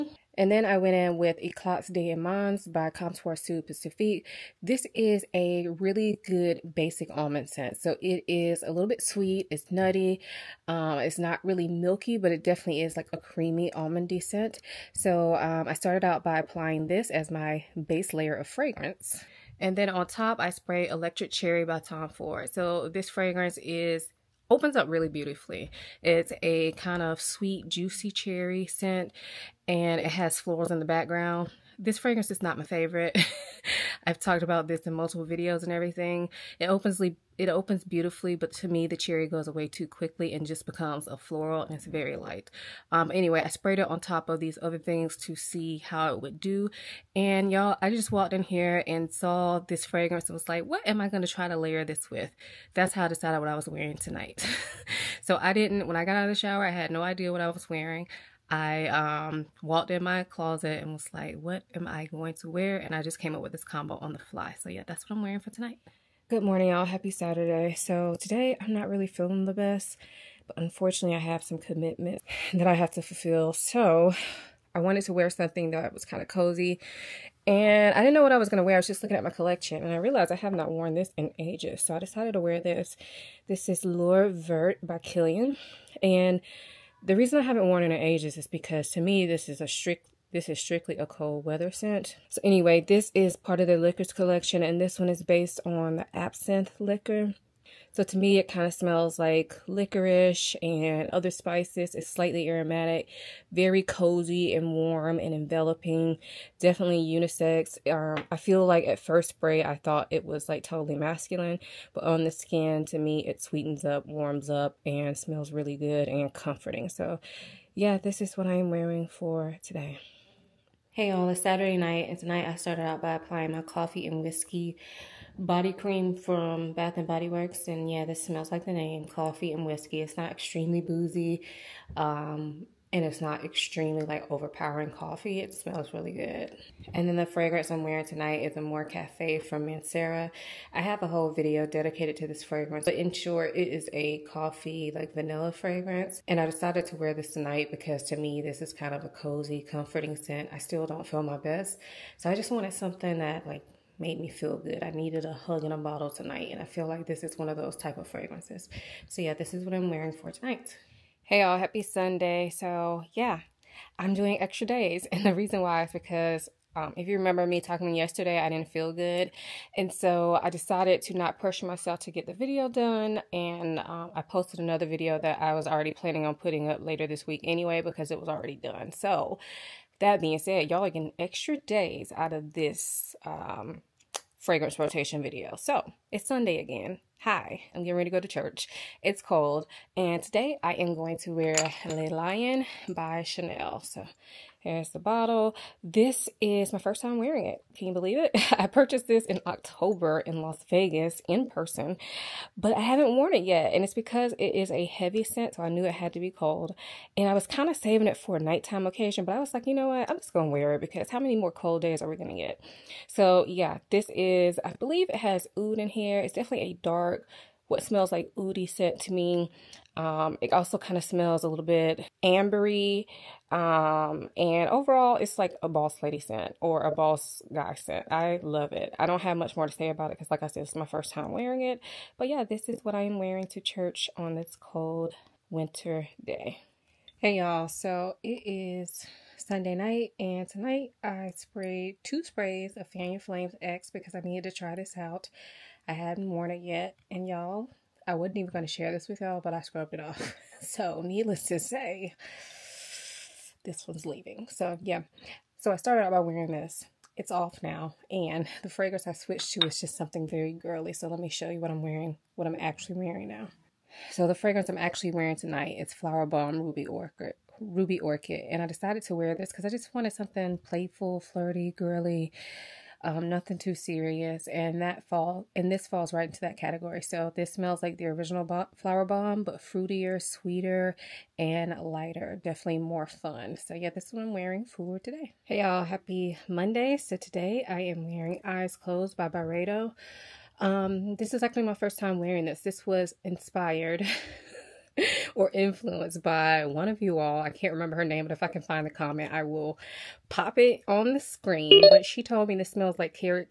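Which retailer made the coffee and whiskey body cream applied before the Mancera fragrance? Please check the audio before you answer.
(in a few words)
Bath and Body Works.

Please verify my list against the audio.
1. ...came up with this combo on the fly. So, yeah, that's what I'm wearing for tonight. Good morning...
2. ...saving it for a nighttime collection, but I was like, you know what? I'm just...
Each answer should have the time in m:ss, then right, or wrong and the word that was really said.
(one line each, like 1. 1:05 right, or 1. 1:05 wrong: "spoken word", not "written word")
1. 1:03 right
2. 3:27 wrong: "occasion", not "collection".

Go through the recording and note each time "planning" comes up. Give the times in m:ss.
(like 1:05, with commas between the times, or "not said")
2:55.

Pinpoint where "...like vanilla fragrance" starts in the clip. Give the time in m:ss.
2:24.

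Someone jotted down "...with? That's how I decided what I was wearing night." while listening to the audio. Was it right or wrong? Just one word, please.
wrong.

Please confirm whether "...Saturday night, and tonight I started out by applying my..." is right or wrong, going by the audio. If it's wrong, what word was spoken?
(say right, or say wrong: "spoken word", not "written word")
right.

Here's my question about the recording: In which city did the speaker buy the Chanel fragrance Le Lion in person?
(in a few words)
Las Vegas.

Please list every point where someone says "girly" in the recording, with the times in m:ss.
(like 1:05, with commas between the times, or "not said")
4:20, 4:31.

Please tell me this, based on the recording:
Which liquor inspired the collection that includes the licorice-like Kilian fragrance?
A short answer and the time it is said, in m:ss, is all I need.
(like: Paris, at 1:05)
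absinthe, at 1:36.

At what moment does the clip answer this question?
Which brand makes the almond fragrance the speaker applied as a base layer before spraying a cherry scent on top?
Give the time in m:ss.
0:02.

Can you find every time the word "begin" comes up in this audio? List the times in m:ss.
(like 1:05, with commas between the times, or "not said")
not said.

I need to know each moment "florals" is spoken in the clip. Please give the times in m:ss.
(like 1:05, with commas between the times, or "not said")
0:30, 0:41.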